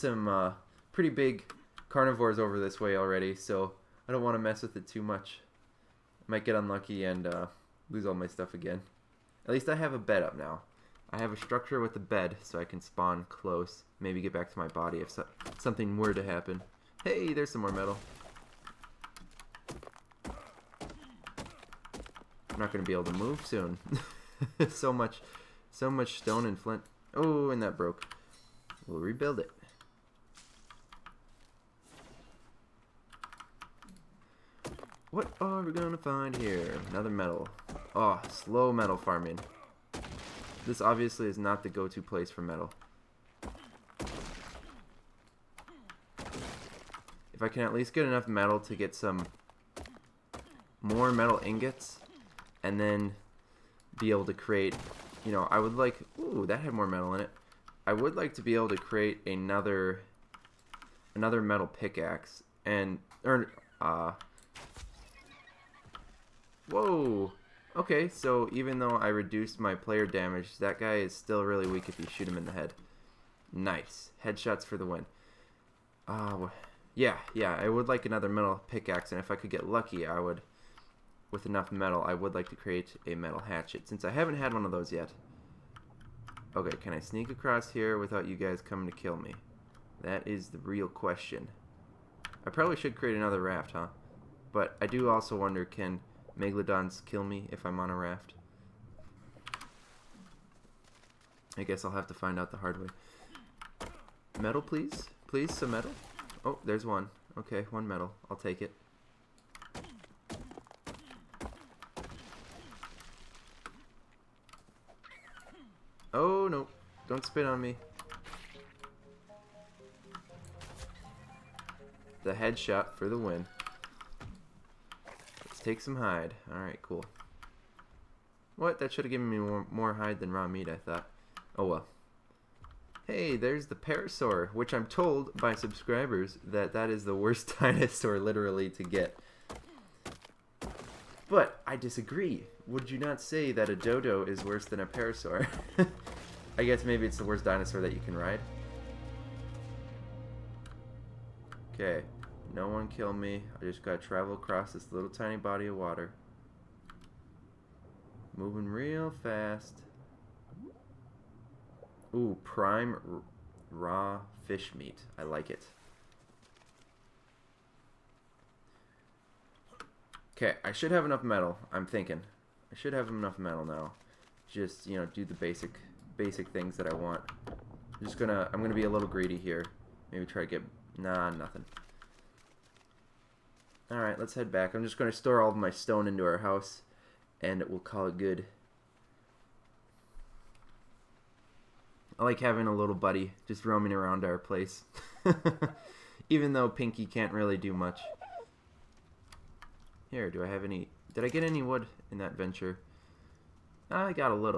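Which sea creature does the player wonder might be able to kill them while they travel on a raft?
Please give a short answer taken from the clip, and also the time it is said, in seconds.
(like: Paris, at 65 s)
Megalodons, at 96 s.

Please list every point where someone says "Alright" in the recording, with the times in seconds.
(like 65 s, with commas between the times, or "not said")
126 s, 183 s.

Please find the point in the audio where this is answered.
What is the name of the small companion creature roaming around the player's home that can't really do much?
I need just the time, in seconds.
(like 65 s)
196 s.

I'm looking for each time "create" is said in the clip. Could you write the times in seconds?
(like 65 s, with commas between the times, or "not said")
54 s, 58 s, 82 s, 92 s.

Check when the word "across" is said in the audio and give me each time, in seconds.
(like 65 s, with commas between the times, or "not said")
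87 s, 154 s.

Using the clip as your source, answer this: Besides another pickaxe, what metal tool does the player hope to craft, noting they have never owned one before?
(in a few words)
Metal hatchet.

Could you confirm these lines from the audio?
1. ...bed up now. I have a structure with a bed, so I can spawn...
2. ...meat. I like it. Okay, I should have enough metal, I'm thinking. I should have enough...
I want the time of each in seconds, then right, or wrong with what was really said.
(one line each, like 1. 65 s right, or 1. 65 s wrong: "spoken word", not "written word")
1. 9 s right
2. 164 s right.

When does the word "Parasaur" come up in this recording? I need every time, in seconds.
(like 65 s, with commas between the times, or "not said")
133 s, 144 s.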